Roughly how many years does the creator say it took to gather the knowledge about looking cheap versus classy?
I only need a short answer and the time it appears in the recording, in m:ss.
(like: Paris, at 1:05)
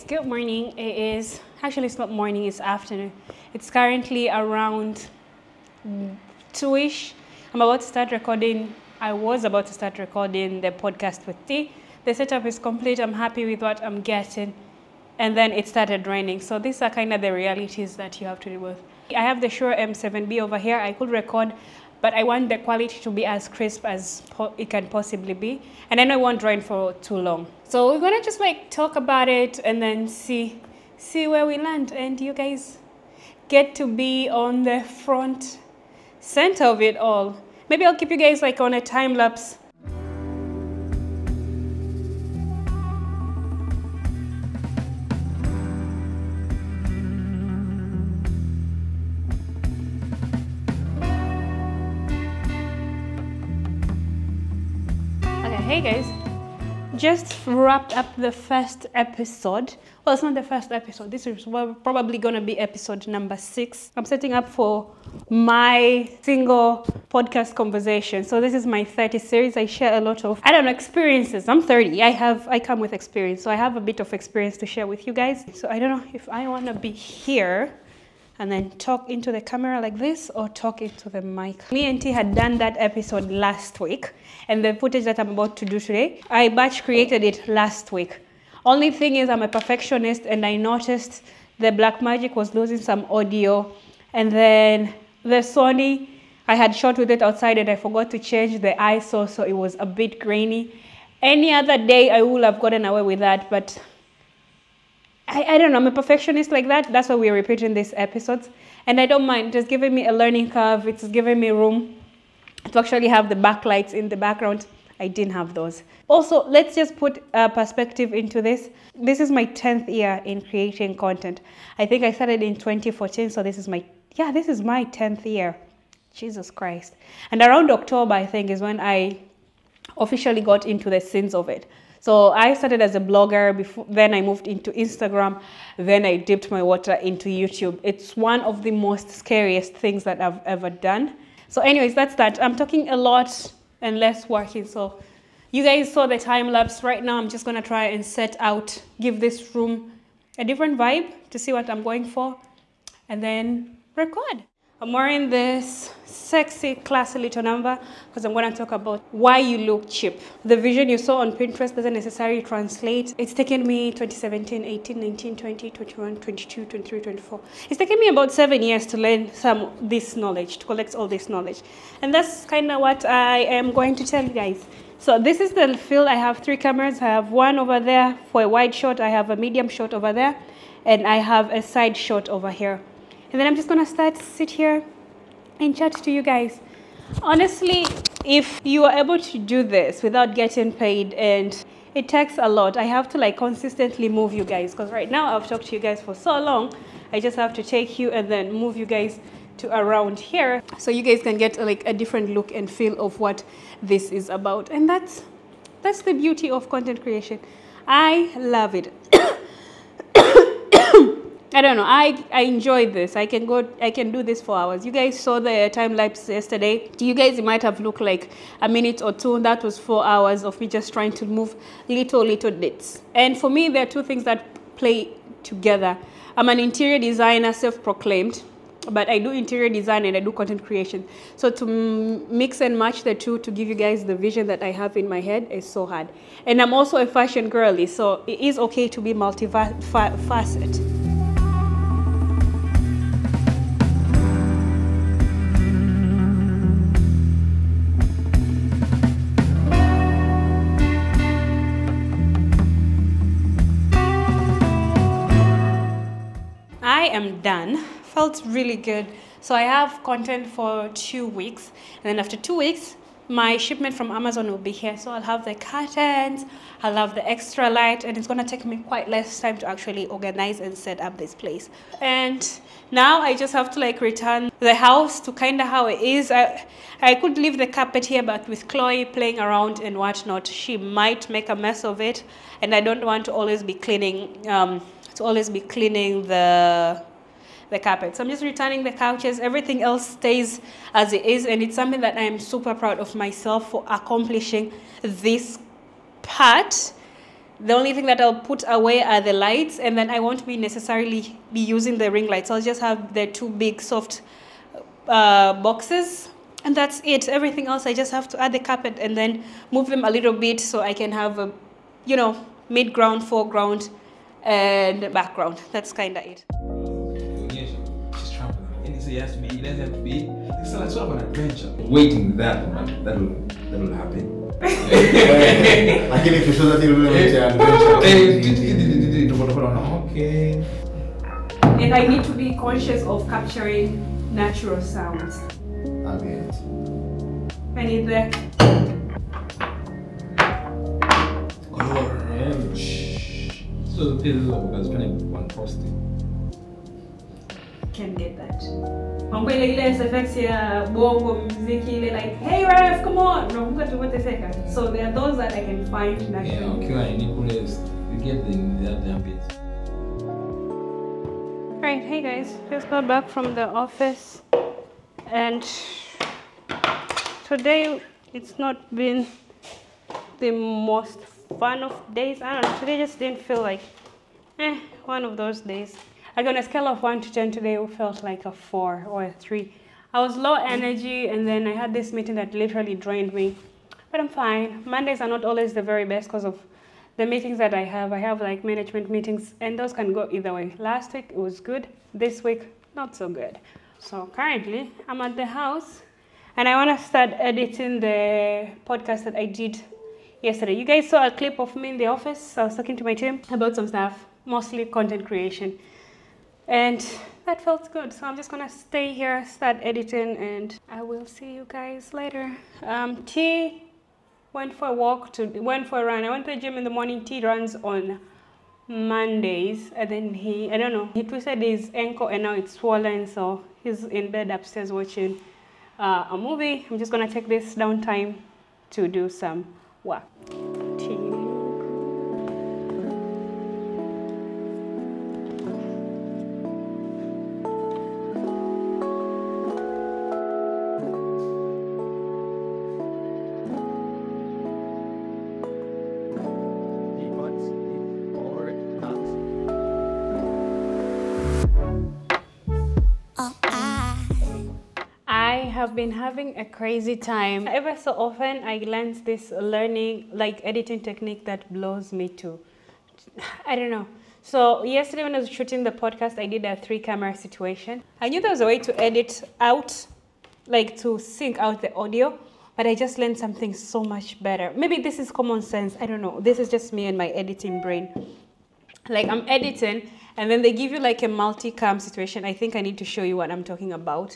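seven years, at 2:48.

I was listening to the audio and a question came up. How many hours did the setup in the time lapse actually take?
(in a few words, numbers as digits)
4.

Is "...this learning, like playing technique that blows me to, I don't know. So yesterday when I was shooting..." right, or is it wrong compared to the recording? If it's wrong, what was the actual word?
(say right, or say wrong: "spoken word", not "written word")
wrong: "editing", not "playing".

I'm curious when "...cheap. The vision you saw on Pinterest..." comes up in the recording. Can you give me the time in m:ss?
2:39.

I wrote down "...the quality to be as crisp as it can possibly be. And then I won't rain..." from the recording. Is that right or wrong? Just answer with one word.
right.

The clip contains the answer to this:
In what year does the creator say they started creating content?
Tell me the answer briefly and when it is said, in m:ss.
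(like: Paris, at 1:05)
2014, at 2:02.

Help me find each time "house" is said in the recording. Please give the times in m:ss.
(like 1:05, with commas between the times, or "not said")
4:34, 6:35.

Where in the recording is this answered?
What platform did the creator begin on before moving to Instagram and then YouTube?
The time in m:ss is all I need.
2:12.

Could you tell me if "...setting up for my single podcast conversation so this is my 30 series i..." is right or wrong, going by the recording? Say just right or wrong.
right.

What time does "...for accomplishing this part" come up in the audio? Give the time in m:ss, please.
4:53.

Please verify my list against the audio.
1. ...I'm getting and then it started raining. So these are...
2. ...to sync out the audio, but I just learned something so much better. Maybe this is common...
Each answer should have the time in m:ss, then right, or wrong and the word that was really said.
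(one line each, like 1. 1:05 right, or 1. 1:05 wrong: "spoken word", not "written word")
1. 0:13 right
2. 7:50 right.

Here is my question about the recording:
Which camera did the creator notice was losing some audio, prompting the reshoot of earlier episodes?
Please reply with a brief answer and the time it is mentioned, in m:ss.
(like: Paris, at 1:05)
Blackmagic, at 1:31.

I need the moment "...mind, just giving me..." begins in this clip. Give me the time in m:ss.
1:49.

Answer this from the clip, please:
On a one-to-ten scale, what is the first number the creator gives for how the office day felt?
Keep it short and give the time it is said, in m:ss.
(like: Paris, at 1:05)
4, at 6:18.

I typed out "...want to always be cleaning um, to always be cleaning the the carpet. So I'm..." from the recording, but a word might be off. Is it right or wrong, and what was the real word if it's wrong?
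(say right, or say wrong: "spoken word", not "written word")
right.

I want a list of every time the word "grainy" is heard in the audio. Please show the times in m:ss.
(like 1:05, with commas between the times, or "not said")
1:40.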